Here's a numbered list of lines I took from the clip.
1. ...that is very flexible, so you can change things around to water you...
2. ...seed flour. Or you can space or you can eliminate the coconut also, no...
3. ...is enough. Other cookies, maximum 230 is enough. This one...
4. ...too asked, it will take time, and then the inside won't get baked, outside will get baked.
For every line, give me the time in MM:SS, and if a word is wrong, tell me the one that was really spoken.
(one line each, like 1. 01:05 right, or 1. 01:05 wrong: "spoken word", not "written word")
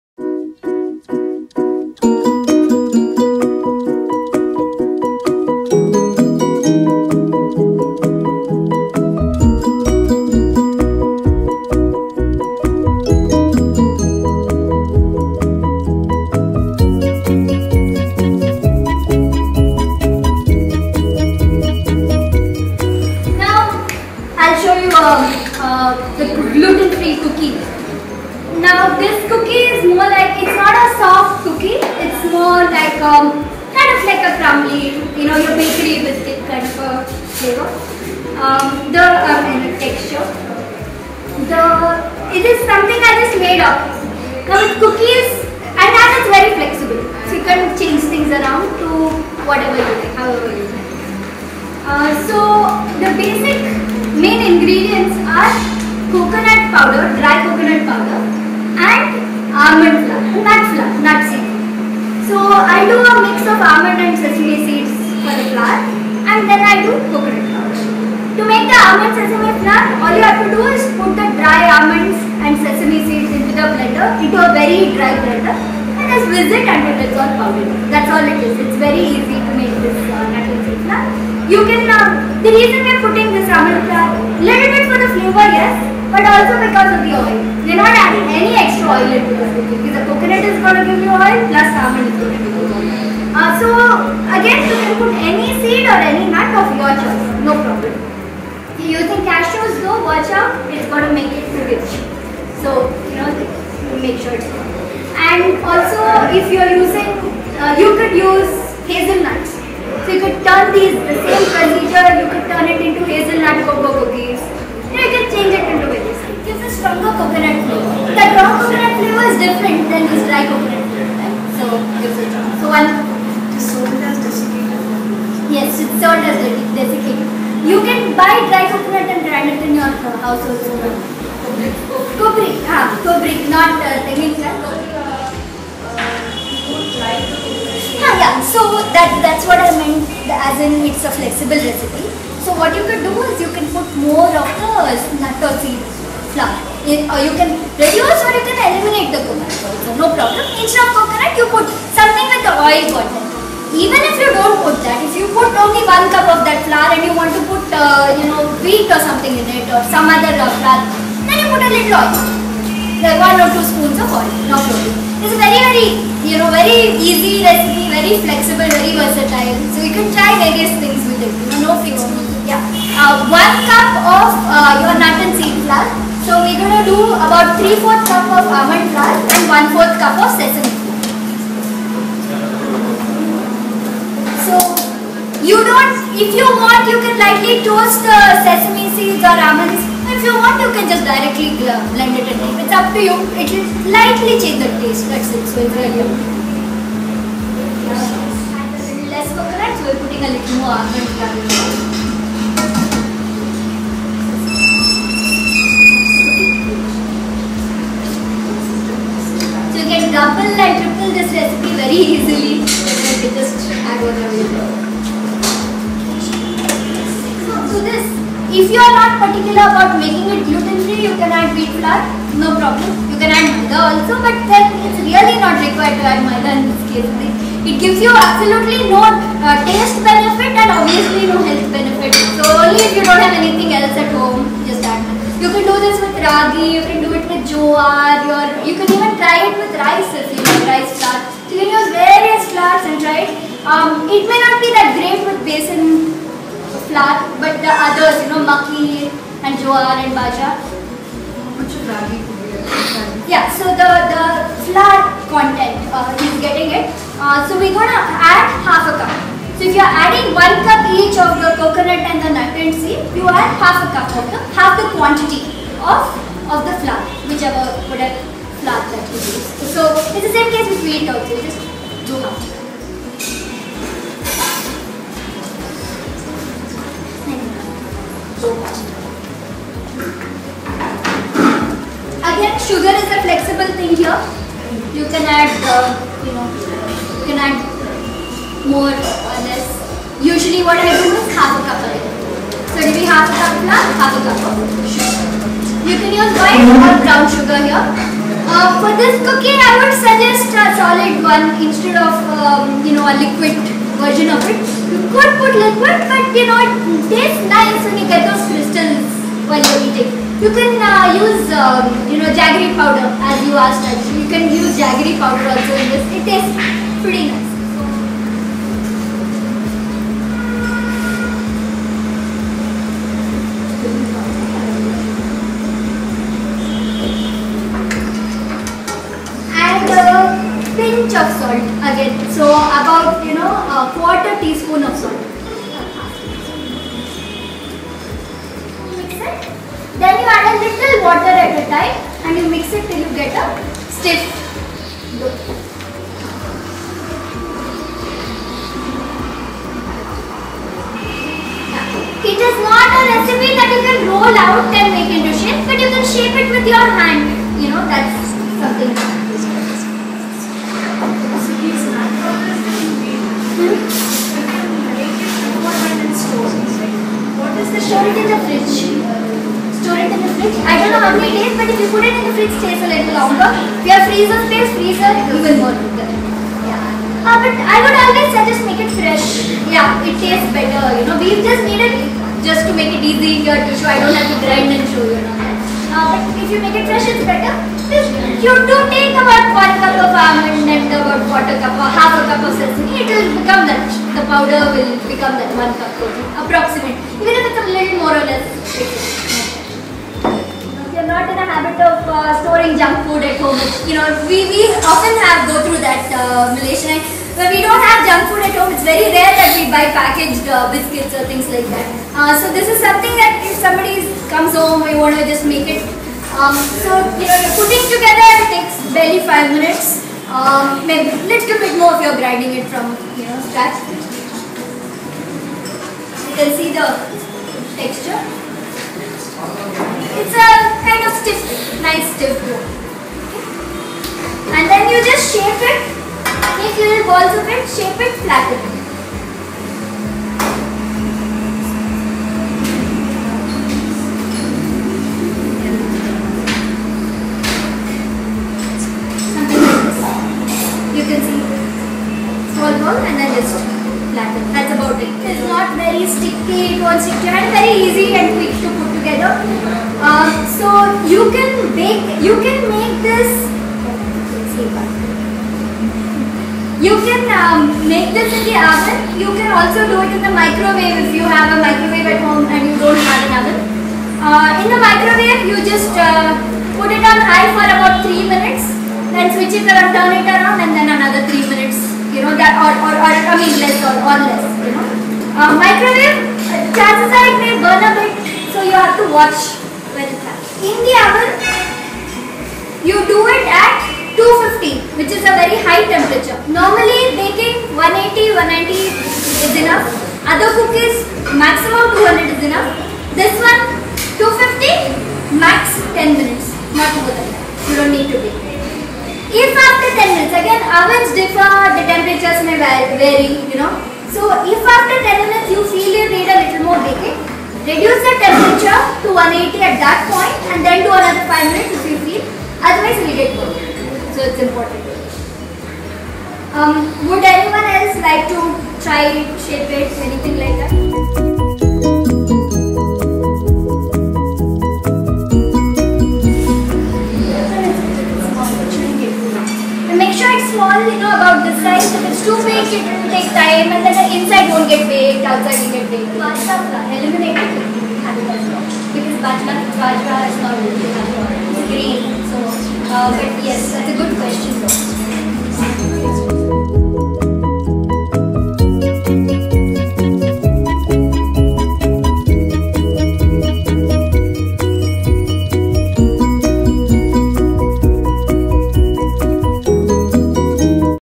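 1. 00:45 wrong: "whatever", not "water"
2. 02:25 wrong: "reduce", not "space"
3. 08:18 wrong: "200", not "230"
4. 09:02 wrong: "baked", not "asked".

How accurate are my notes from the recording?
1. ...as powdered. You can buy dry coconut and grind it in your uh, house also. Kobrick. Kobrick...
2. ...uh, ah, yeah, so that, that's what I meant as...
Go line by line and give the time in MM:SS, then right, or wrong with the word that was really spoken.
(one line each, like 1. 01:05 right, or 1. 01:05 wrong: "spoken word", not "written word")
1. 02:06 wrong: "desiccated", not "powdered"
2. 02:15 right.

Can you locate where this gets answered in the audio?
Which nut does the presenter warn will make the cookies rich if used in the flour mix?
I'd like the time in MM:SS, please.
01:39.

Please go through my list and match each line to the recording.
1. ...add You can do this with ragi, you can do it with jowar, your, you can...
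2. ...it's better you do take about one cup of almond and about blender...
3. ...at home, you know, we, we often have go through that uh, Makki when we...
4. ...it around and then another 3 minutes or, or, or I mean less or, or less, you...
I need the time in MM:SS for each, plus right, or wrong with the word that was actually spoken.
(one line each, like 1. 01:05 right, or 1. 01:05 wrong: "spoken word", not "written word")
1. 03:54 right
2. 06:27 wrong: "quarter", not "blender"
3. 06:43 wrong: "Malaysian", not "Makki"
4. 08:00 right.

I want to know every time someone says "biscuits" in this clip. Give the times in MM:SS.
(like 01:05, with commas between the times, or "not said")
06:50.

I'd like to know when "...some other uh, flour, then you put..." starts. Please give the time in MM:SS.
02:39.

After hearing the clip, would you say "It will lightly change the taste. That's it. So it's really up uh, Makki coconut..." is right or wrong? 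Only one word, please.
wrong.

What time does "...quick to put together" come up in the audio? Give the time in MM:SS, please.
07:38.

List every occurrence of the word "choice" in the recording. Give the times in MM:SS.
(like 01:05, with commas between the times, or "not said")
01:36.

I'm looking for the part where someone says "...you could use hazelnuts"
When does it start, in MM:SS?
01:47.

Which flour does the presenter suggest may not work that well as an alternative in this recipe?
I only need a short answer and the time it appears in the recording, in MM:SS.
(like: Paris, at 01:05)
Besan, at 04:05.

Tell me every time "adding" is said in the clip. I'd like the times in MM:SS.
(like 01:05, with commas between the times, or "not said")
01:27, 04:20.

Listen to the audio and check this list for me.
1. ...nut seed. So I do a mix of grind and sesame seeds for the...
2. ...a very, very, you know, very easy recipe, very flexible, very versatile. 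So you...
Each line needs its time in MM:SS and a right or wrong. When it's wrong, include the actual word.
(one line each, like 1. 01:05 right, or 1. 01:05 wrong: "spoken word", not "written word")
1. 01:01 wrong: "almond", not "grind"
2. 02:45 right.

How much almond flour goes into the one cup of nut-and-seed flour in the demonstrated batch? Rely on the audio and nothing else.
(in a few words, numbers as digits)
3/4 cup.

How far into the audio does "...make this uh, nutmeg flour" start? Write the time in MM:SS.
01:19.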